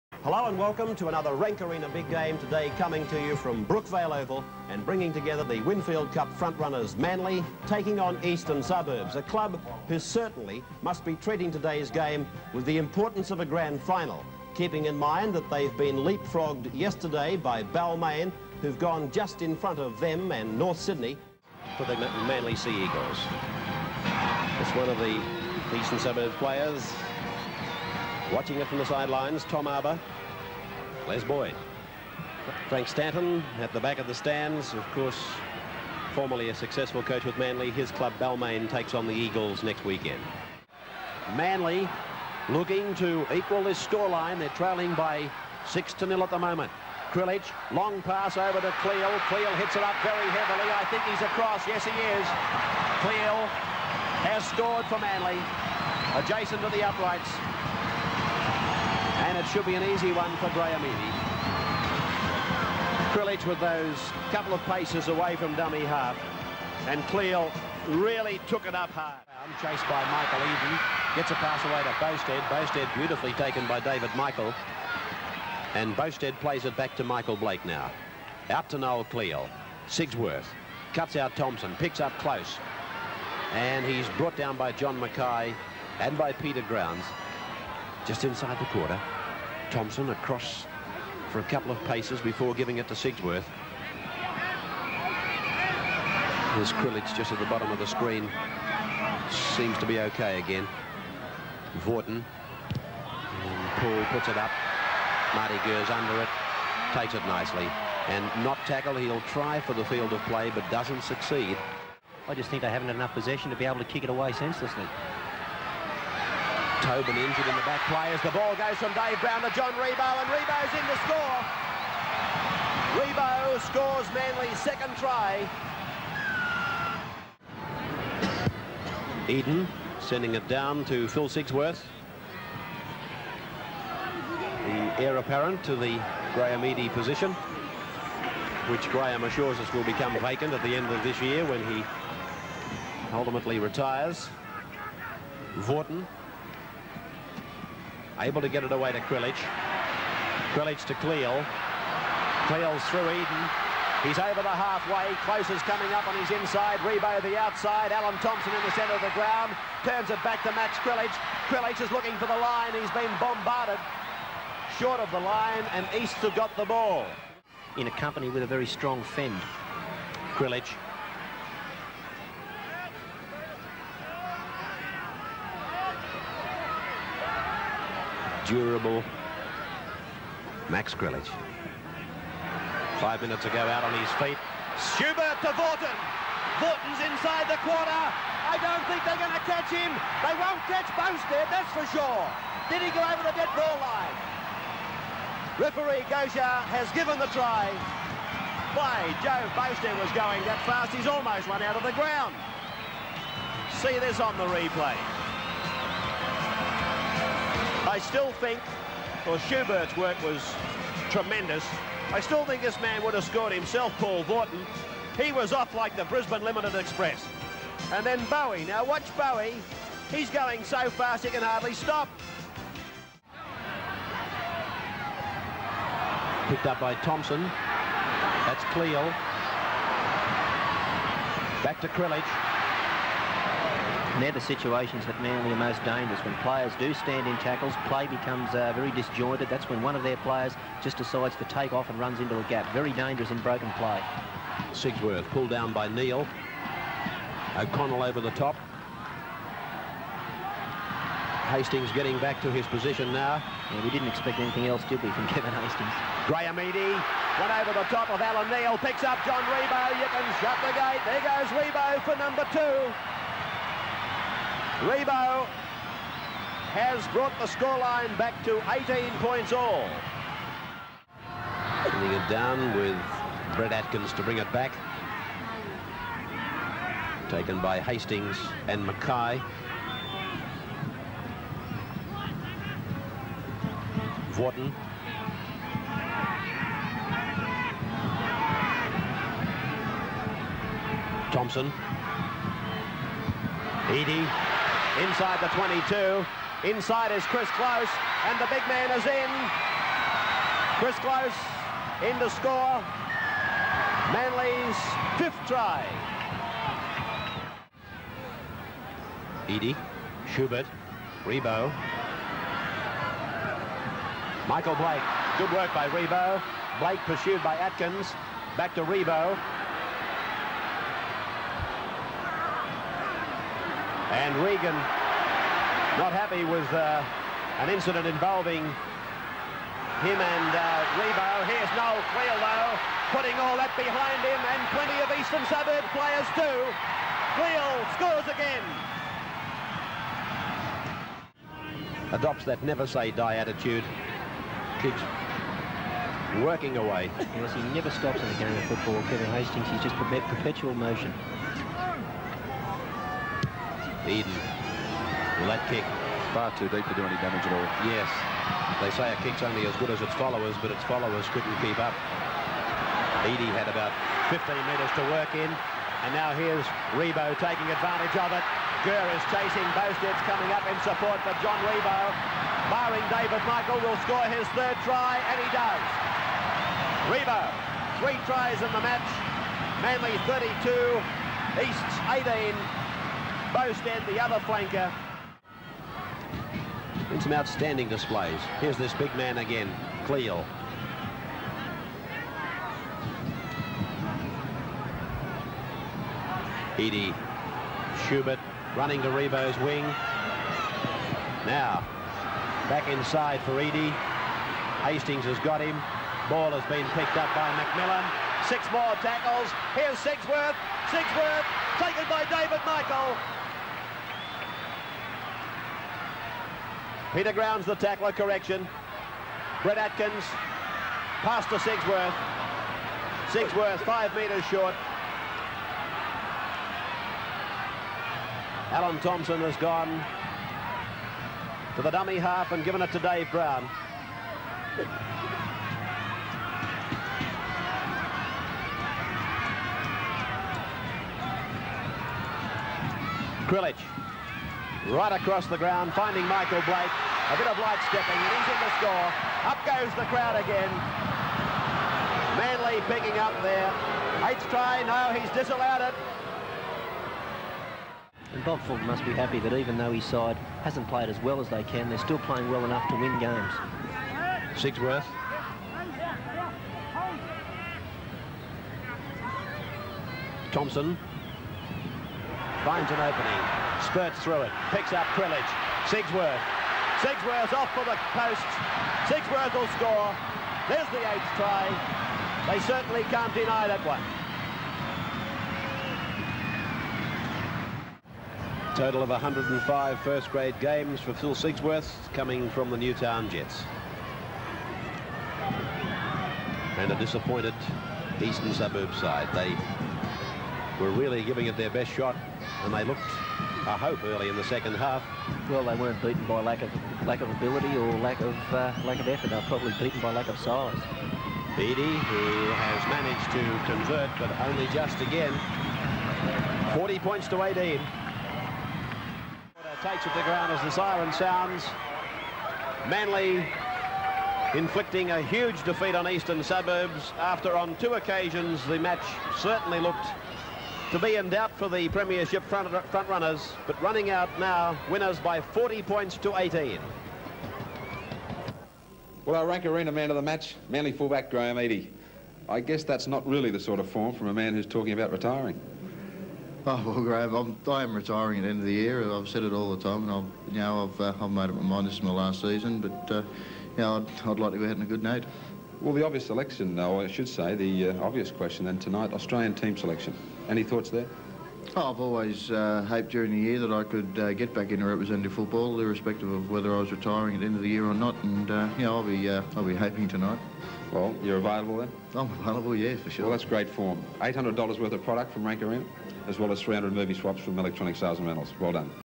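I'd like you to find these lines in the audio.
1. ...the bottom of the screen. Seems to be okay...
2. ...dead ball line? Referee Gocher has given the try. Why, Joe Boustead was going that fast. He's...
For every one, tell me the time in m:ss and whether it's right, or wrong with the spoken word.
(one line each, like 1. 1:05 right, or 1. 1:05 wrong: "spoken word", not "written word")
1. 1:37 right
2. 3:13 right.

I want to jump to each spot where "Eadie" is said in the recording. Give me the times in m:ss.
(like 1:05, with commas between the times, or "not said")
2:16, 4:16, 4:53, 5:09, 6:03, 6:36, 6:43, 9:01.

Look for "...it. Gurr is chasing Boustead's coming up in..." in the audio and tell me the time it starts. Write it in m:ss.
6:08.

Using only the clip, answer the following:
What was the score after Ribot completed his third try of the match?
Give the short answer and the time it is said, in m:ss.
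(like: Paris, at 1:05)
Manly 32, Easts 18, at 6:19.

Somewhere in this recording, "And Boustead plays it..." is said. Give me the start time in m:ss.
1:15.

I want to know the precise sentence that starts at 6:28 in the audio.
Here's this big man again, Cleal.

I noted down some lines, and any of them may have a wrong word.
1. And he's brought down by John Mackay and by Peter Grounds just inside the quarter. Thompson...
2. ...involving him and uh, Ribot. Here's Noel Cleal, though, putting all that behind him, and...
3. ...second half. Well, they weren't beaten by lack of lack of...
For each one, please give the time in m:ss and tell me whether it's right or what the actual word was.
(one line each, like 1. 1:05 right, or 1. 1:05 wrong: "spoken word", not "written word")
1. 1:23 right
2. 5:28 right
3. 8:24 right.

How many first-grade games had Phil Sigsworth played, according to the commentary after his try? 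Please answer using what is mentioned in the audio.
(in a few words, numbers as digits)
105.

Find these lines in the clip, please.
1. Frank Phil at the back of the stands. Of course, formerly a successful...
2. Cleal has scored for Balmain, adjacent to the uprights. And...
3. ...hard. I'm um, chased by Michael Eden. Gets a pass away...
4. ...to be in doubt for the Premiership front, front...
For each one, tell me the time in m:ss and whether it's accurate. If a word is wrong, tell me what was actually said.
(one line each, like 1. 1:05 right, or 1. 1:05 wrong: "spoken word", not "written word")
1. 0:32 wrong: "Stanton", not "Phil"
2. 0:53 wrong: "Manly", not "Balmain"
3. 1:08 right
4. 8:50 right.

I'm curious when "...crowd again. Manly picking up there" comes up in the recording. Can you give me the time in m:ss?
7:30.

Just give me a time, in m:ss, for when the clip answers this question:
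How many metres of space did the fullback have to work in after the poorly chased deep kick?
6:04.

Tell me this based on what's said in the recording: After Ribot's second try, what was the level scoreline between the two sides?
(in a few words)
18 points all.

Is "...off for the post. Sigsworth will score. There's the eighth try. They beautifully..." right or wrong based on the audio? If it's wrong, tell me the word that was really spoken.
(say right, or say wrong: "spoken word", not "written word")
wrong: "certainly", not "beautifully".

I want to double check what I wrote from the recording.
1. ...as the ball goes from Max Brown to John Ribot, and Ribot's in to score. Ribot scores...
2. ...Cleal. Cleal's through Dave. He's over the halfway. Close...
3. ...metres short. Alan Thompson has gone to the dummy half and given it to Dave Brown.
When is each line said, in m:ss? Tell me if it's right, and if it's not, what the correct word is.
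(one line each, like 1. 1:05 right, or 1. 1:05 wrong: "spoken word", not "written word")
1. 1:58 wrong: "Dave", not "Max"
2. 2:31 wrong: "Eden", not "Dave"
3. 7:04 right.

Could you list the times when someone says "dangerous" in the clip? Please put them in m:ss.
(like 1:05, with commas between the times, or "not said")
3:55, 4:02.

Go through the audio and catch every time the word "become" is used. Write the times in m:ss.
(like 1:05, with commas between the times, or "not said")
2:19, 3:58.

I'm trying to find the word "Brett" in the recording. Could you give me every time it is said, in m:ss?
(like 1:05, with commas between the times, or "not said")
4:33, 6:59.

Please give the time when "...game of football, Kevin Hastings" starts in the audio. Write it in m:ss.
5:48.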